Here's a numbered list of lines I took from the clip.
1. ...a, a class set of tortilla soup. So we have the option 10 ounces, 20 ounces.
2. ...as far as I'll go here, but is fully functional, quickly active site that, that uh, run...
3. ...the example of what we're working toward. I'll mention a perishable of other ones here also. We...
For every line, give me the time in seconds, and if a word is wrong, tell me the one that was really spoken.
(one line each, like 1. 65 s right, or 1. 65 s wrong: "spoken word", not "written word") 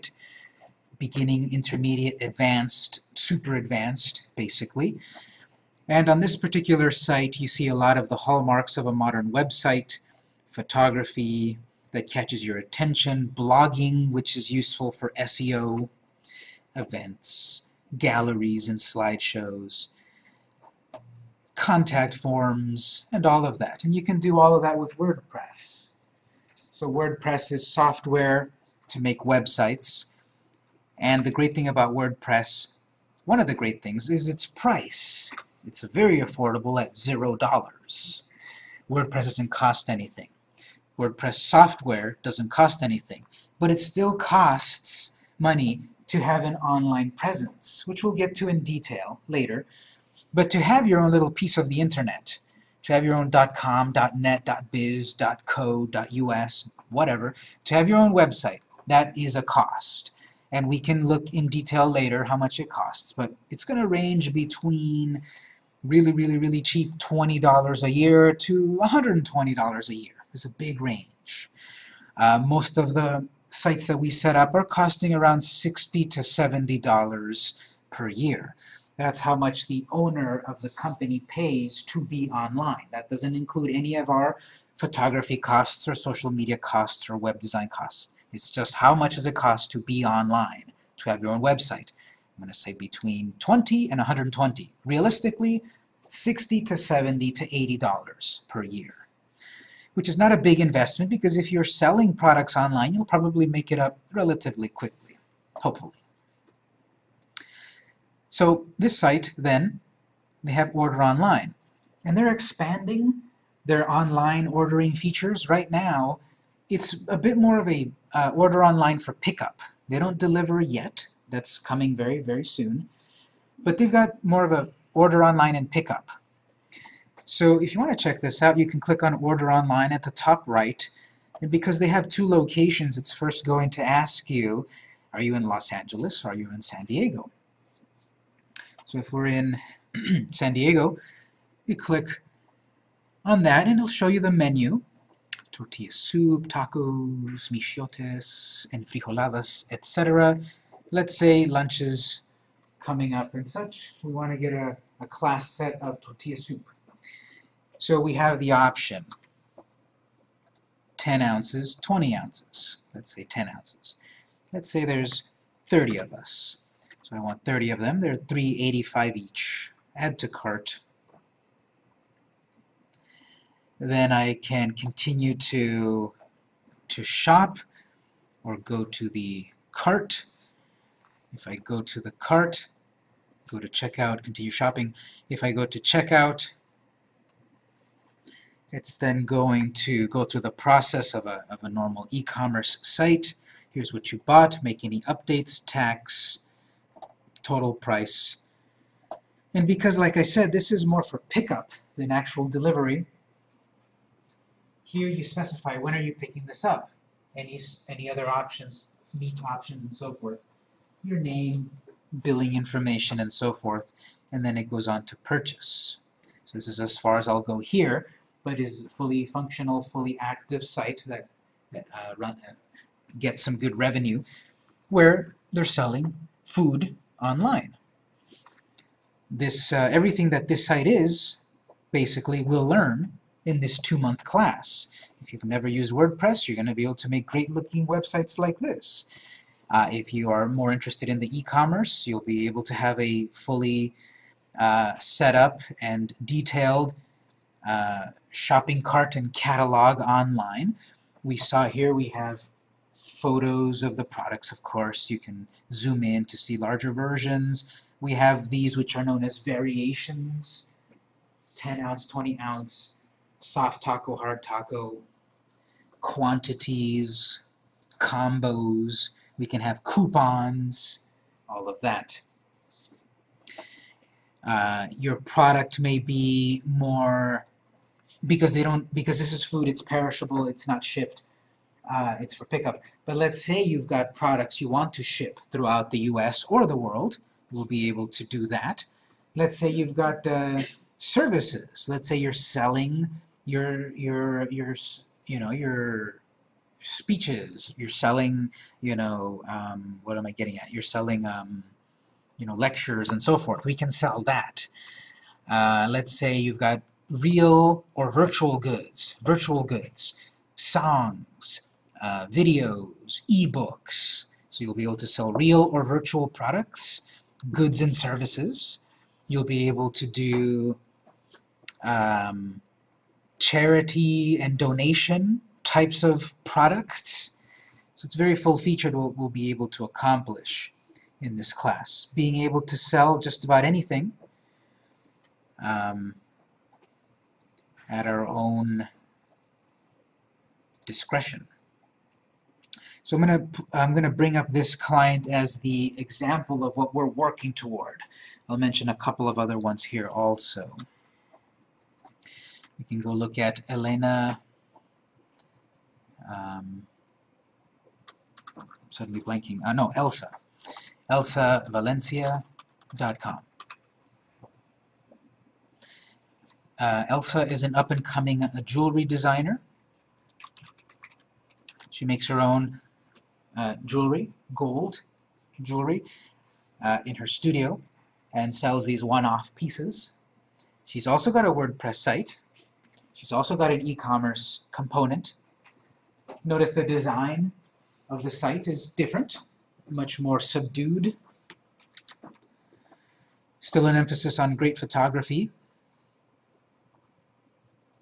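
1. 154 s right
2. 216 s wrong: "fully", not "quickly"
3. 345 s wrong: "couple", not "perishable".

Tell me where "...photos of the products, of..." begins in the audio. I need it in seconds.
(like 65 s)
253 s.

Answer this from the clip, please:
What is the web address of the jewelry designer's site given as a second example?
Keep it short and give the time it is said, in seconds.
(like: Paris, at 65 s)
ElsaValencia.com, at 361 s.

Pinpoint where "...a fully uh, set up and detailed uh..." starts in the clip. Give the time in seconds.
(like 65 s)
242 s.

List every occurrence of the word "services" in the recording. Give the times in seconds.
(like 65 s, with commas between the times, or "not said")
290 s, 317 s.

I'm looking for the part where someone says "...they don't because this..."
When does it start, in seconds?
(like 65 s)
278 s.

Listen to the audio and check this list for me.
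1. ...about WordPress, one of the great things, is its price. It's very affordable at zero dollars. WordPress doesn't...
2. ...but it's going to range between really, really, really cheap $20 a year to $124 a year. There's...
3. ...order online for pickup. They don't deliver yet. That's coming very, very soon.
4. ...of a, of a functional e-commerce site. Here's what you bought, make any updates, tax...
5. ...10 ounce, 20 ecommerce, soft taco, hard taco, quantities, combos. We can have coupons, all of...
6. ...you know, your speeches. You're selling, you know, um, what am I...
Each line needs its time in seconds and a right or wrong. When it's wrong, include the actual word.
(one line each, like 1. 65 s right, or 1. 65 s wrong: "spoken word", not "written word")
1. 31 s right
2. 63 s wrong: "120", not "124"
3. 118 s right
4. 191 s wrong: "normal", not "functional"
5. 261 s wrong: "ounce", not "ecommerce"
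6. 295 s right.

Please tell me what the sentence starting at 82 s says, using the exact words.
That doesn't include any of our photography costs or social media costs or web design costs.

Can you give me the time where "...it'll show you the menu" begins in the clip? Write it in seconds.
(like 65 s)
143 s.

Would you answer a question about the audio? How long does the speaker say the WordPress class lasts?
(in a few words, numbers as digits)
2 months.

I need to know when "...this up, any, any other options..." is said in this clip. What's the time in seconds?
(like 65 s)
206 s.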